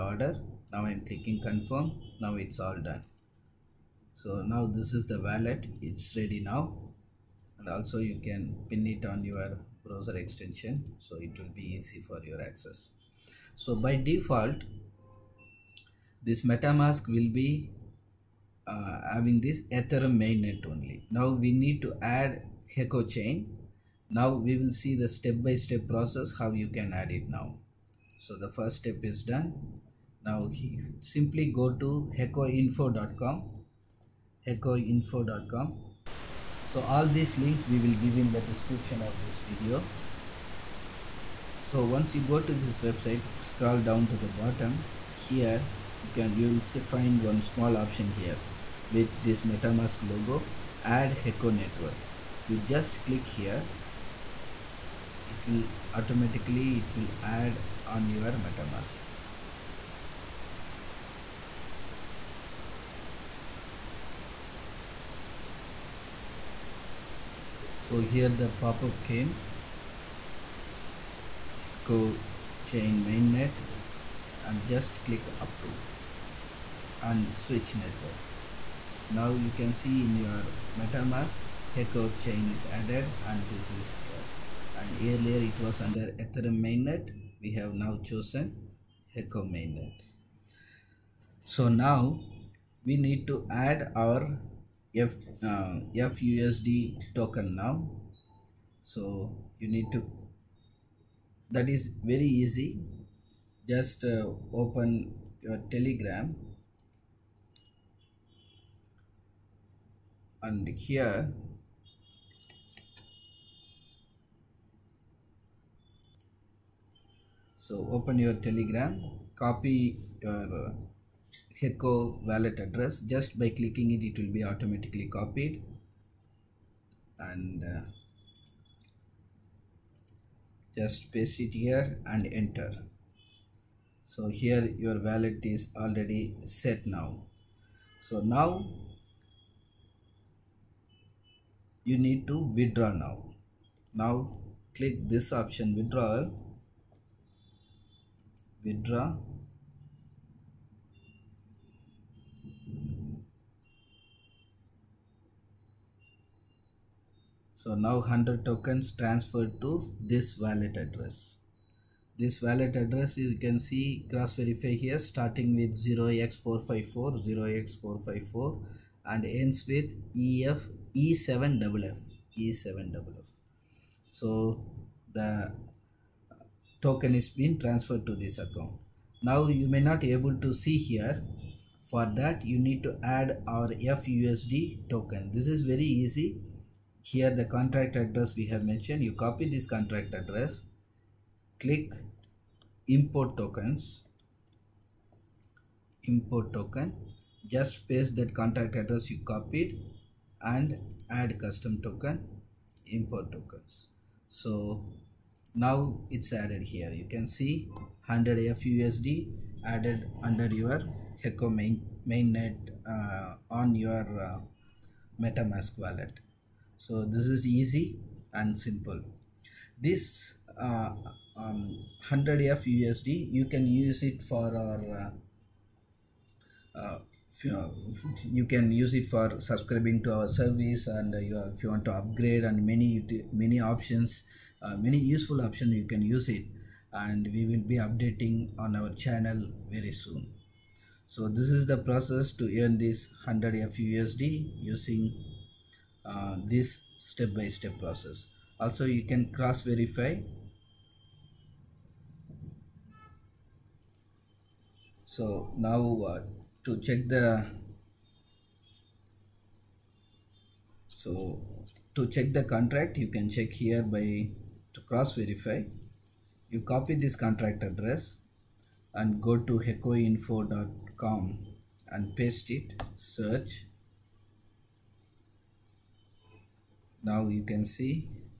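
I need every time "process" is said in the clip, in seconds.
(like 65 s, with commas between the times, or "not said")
25 s, 241 s, 247 s.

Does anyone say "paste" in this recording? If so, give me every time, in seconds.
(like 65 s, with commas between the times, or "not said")
131 s, 197 s, 272 s.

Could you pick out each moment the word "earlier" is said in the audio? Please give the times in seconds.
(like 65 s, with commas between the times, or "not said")
84 s.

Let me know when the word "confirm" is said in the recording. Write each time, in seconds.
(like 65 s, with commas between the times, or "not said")
1 s.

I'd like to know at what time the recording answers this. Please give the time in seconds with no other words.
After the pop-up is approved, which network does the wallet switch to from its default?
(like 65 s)
71 s.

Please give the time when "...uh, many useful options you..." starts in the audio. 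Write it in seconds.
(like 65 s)
234 s.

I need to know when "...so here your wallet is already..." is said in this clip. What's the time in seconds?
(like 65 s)
134 s.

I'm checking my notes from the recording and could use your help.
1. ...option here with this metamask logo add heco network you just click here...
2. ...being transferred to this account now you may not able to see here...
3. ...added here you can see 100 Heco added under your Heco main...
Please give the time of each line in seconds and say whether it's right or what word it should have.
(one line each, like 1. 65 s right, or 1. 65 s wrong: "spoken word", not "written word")
1. 47 s right
2. 177 s right
3. 206 s wrong: "FUSD", not "Heco".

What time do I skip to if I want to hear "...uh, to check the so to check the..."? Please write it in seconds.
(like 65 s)
256 s.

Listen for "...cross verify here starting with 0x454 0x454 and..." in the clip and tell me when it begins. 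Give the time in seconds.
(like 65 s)
164 s.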